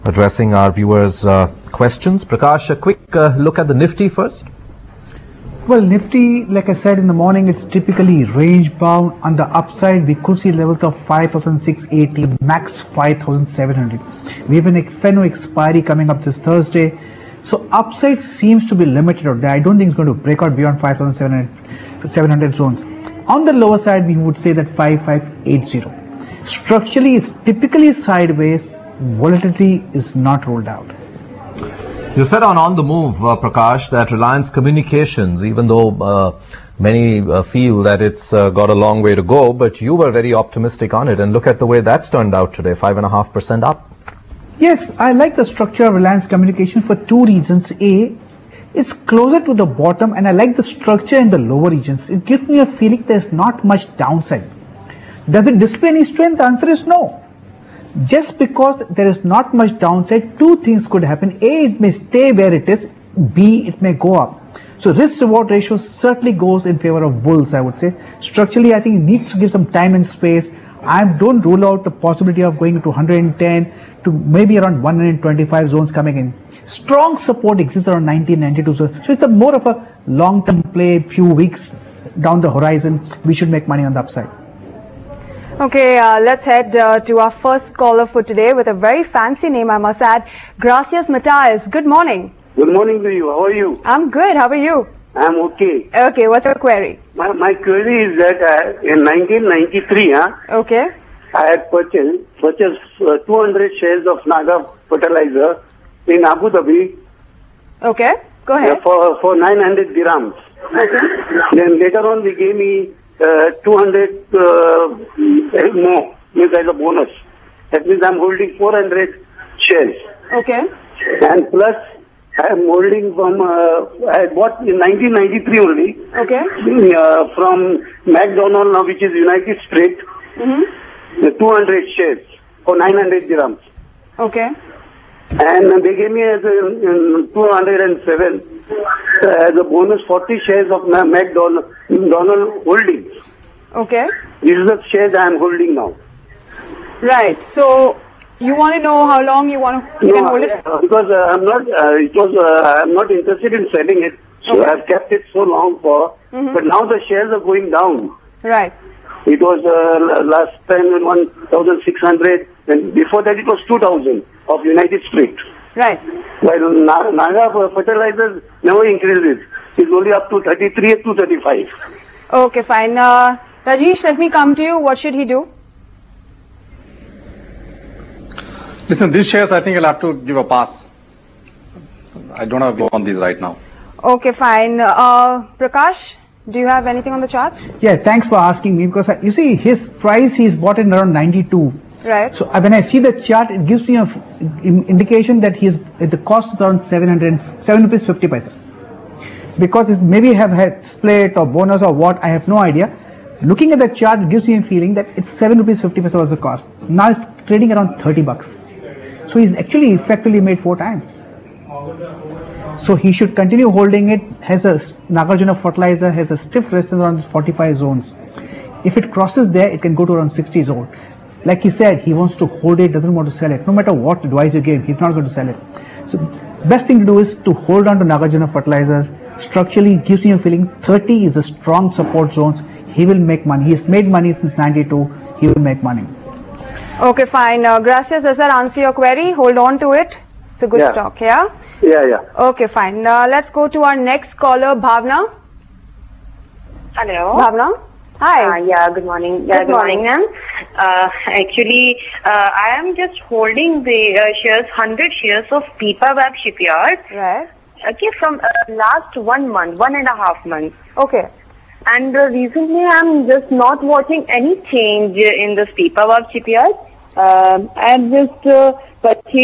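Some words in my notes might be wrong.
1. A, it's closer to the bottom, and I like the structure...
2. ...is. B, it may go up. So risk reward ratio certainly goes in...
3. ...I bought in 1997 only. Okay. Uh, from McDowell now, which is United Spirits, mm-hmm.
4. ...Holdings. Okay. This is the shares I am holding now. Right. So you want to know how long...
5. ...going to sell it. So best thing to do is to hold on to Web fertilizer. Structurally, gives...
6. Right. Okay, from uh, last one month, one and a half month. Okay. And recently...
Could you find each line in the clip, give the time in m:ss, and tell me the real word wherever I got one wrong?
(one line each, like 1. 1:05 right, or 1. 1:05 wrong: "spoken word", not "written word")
1. 0:47 right
2. 1:02 right
3. 2:04 wrong: "1993", not "1997"
4. 2:22 right
5. 3:45 wrong: "Nagarjuna", not "Web"
6. 4:17 right.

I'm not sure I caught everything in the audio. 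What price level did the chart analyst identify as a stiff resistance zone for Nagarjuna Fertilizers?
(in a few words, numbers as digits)
45.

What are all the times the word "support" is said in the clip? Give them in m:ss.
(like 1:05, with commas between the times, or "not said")
1:17, 3:51.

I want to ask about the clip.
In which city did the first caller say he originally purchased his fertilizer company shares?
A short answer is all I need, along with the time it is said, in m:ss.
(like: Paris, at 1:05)
Abu Dhabi, at 1:46.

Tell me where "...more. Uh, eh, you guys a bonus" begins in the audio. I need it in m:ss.
1:54.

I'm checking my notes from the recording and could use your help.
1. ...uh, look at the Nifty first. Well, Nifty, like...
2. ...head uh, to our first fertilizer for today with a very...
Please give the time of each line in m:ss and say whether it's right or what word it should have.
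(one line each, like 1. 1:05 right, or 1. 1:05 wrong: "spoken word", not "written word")
1. 0:03 right
2. 1:26 wrong: "caller", not "fertilizer".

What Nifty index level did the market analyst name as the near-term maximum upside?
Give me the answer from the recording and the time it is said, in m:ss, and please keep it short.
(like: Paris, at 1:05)
5,700, at 0:12.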